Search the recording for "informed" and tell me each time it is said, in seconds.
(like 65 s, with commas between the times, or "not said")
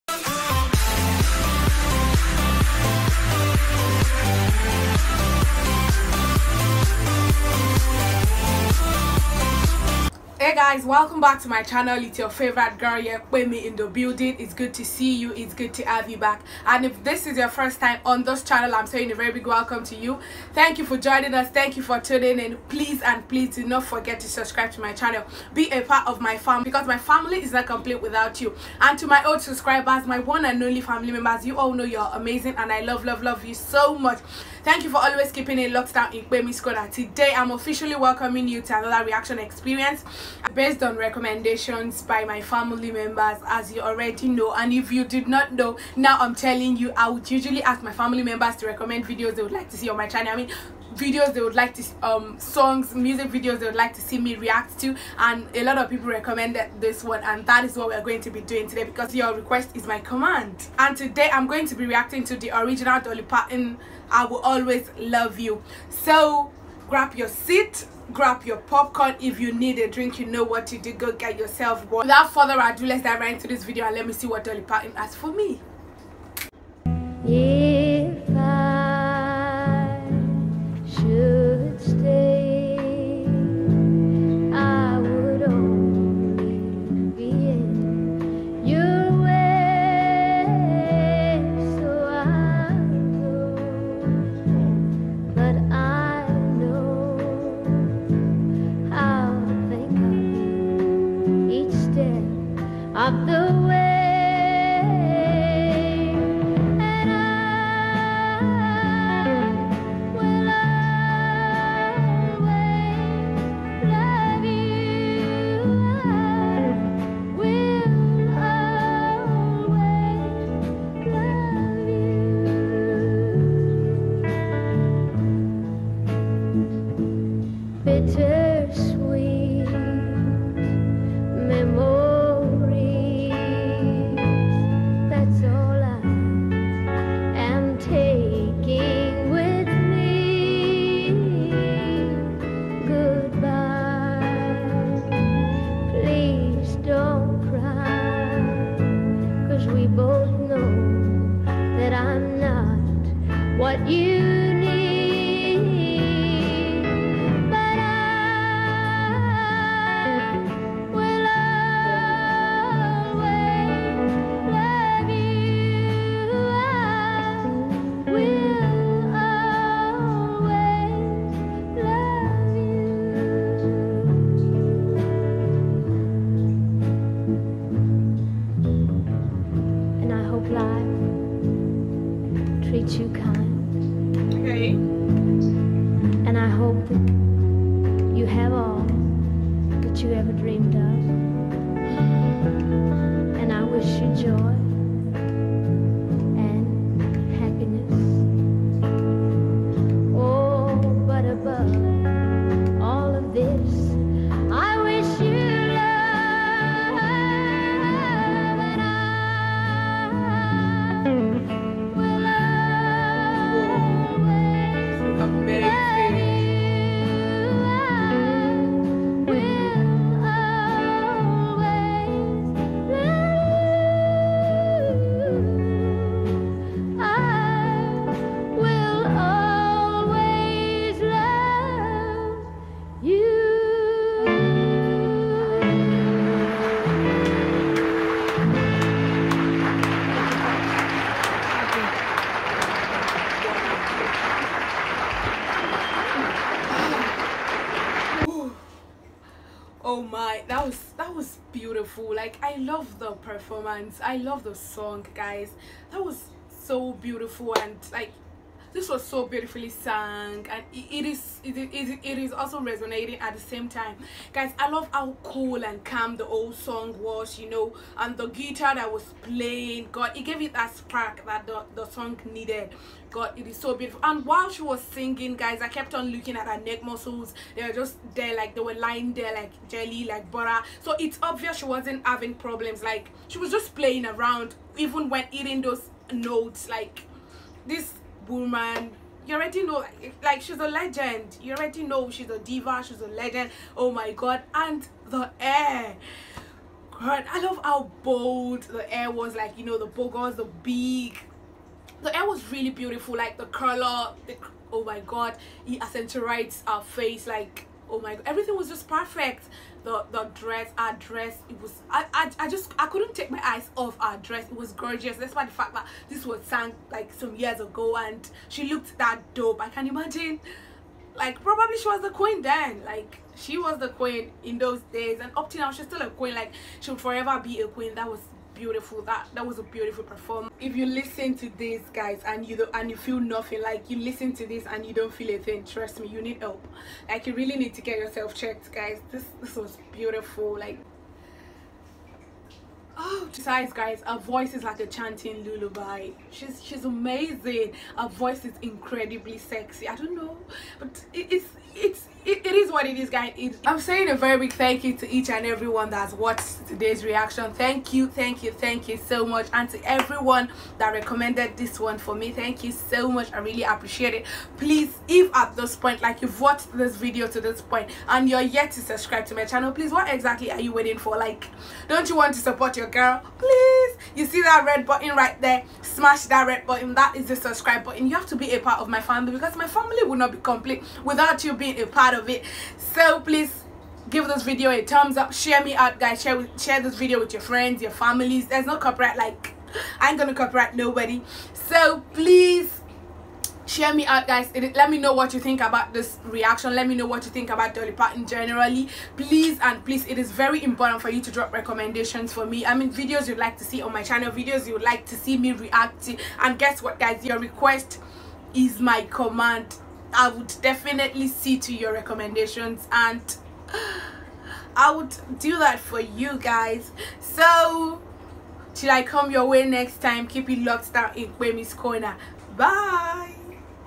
not said.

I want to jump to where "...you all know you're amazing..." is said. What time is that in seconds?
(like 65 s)
31 s.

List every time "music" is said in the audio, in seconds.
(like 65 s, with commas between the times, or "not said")
52 s.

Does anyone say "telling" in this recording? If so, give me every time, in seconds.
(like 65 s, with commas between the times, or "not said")
46 s.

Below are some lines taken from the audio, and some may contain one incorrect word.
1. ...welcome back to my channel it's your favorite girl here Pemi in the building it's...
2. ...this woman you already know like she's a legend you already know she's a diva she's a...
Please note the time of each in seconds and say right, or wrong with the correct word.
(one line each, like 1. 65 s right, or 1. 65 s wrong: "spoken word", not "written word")
1. 10 s right
2. 287 s right.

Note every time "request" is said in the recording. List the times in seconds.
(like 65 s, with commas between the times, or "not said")
59 s, 407 s.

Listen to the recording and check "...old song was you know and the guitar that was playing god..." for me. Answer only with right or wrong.
right.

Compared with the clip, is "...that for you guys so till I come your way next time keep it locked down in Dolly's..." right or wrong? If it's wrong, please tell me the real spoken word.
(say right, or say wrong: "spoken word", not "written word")
wrong: "Pemi", not "Dolly".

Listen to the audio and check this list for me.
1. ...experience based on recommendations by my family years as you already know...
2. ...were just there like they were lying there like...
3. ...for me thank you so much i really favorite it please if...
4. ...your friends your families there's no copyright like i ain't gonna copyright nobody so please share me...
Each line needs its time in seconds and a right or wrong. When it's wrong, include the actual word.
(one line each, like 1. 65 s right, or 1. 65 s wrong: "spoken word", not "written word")
1. 39 s wrong: "members", not "years"
2. 277 s right
3. 361 s wrong: "appreciate", not "favorite"
4. 387 s right.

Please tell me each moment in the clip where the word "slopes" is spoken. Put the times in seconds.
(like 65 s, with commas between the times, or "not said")
not said.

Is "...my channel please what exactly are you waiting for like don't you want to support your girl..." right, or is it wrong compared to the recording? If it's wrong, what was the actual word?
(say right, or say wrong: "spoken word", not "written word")
right.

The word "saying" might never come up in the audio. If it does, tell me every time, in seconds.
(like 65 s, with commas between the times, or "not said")
18 s, 353 s.